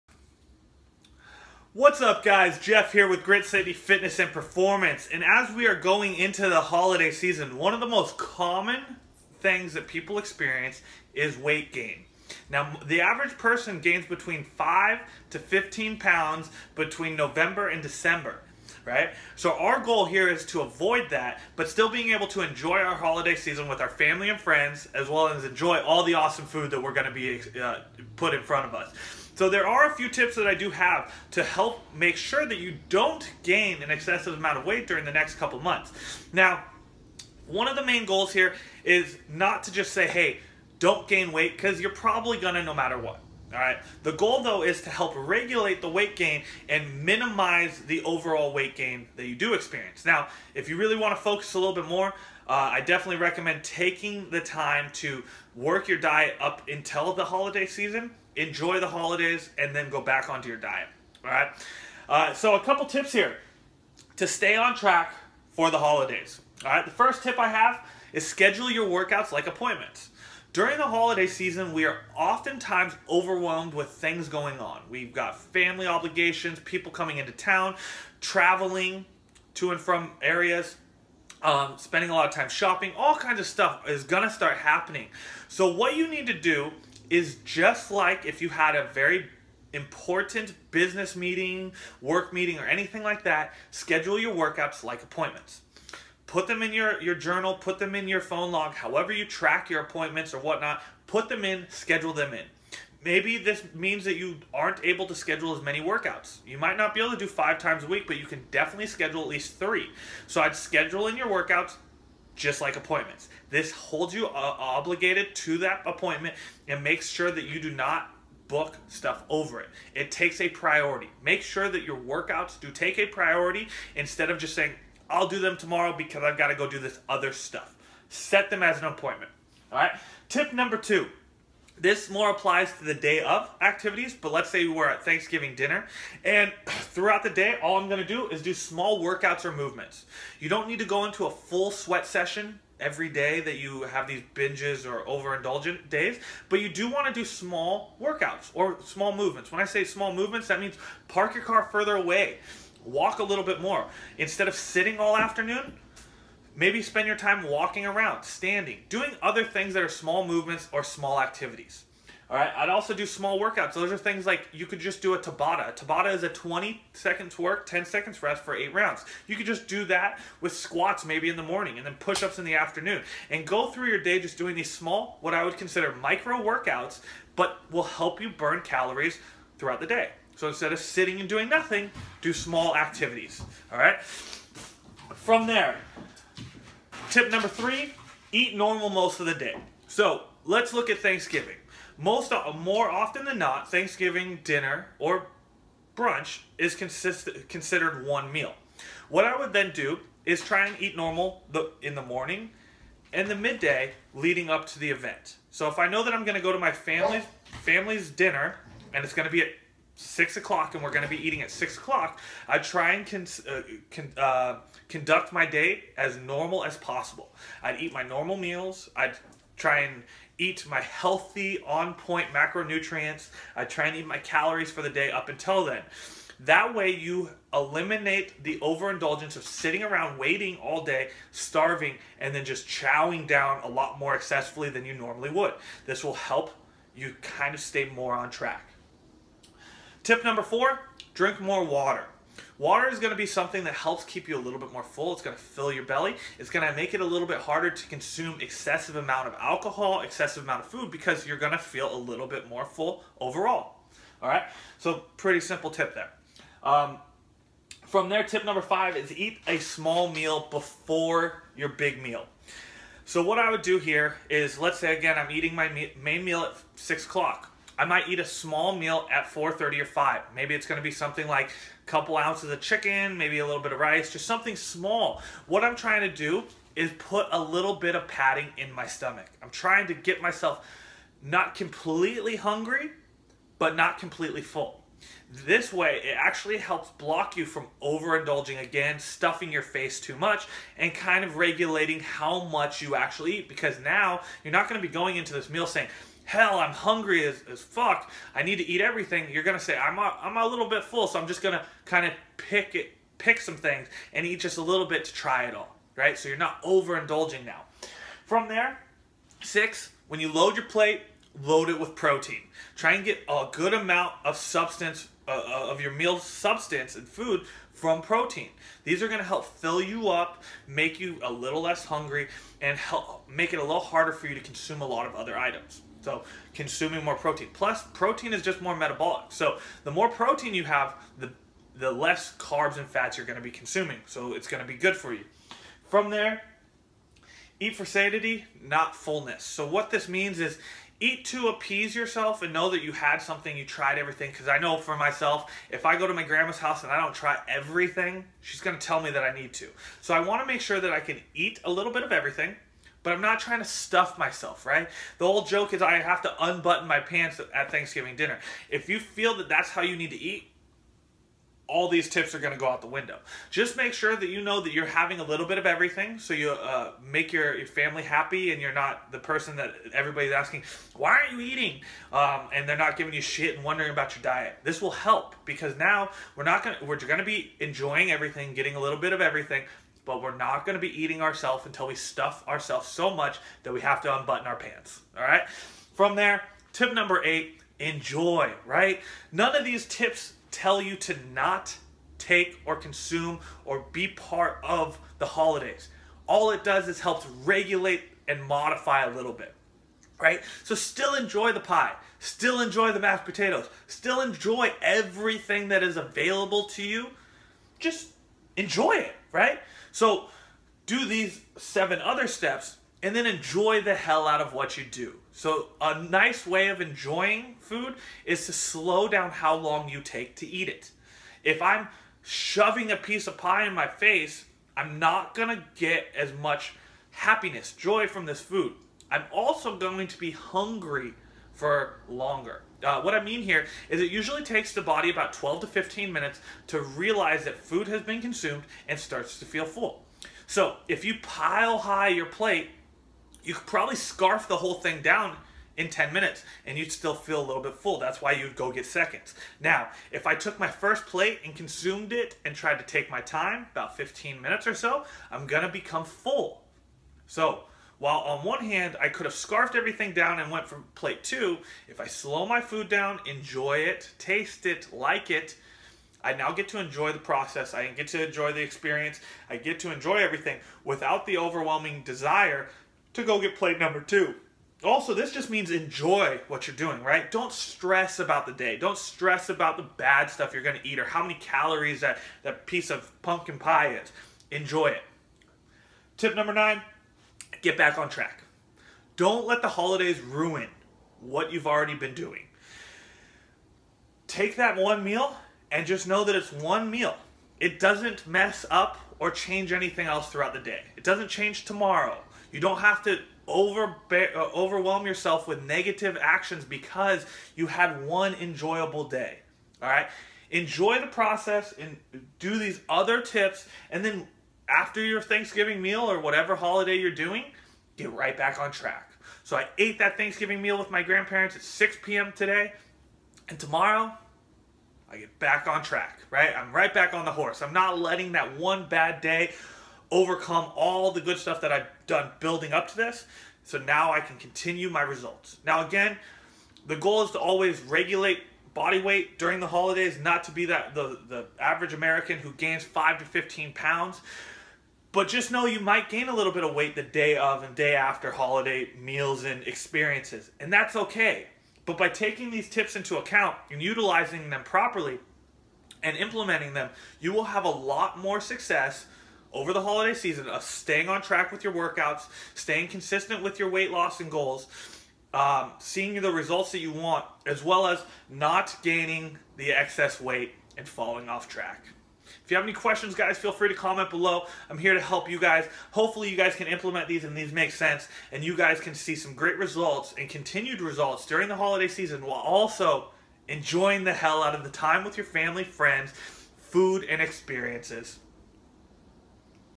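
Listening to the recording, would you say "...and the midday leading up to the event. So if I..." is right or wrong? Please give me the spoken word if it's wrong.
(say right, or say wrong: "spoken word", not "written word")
right.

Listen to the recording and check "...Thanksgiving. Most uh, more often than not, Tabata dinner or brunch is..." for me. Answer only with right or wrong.
wrong.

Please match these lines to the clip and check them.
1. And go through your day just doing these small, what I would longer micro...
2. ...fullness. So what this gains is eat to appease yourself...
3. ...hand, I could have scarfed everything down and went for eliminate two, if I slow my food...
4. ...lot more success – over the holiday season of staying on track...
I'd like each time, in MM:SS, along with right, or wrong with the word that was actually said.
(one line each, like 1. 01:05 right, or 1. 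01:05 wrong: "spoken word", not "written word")
1. 02:53 wrong: "consider", not "longer"
2. 05:38 wrong: "means", not "gains"
3. 07:38 wrong: "plate", not "eliminate"
4. 09:17 right.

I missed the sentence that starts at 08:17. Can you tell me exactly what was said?
It doesn't mess up or change anything else throughout the day.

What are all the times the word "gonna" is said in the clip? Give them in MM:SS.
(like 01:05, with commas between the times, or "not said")
00:42, 01:24, 02:17, 07:35.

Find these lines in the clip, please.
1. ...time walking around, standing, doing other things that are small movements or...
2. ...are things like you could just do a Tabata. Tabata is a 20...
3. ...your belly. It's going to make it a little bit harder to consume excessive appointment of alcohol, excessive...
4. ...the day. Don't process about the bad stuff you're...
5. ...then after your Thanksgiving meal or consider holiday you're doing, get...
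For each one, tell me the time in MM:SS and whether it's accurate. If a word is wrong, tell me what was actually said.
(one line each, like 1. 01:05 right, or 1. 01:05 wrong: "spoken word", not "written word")
1. 02:37 right
2. 02:43 right
3. 04:05 wrong: "amount", not "appointment"
4. 07:58 wrong: "stress", not "process"
5. 08:34 wrong: "whatever", not "consider".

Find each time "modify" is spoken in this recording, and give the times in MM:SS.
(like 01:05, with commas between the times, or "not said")
06:38.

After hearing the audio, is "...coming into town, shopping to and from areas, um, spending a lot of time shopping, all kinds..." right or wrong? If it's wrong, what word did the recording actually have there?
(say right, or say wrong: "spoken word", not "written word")
wrong: "traveling", not "shopping".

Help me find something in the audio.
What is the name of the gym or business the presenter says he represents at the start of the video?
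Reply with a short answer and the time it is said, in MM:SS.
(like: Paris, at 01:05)
Grit City Fitness and Performance, at 00:03.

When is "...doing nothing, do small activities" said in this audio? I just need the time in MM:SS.
03:01.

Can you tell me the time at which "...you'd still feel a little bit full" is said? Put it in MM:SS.
07:26.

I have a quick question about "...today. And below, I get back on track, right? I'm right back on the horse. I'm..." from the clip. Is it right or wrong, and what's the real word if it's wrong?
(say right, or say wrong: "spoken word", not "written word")
wrong: "tomorrow", not "below".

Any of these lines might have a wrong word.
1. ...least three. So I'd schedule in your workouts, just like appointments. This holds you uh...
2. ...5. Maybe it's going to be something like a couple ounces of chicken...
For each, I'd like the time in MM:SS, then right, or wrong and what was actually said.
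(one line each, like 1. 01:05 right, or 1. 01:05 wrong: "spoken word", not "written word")
1. 01:49 right
2. 04:29 right.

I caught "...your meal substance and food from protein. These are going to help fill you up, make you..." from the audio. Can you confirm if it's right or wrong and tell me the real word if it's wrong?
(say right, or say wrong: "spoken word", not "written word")
right.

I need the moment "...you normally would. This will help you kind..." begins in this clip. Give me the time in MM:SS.
03:54.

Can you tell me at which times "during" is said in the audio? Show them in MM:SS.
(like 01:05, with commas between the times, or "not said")
00:34, 01:10, 08:59, 09:41.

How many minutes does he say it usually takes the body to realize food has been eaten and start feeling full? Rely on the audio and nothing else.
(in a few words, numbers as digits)
12 to 15 minutes.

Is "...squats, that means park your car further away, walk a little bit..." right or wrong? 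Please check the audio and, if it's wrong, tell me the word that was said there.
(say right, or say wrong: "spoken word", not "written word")
wrong: "movements", not "squats".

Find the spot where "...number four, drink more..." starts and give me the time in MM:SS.
04:00.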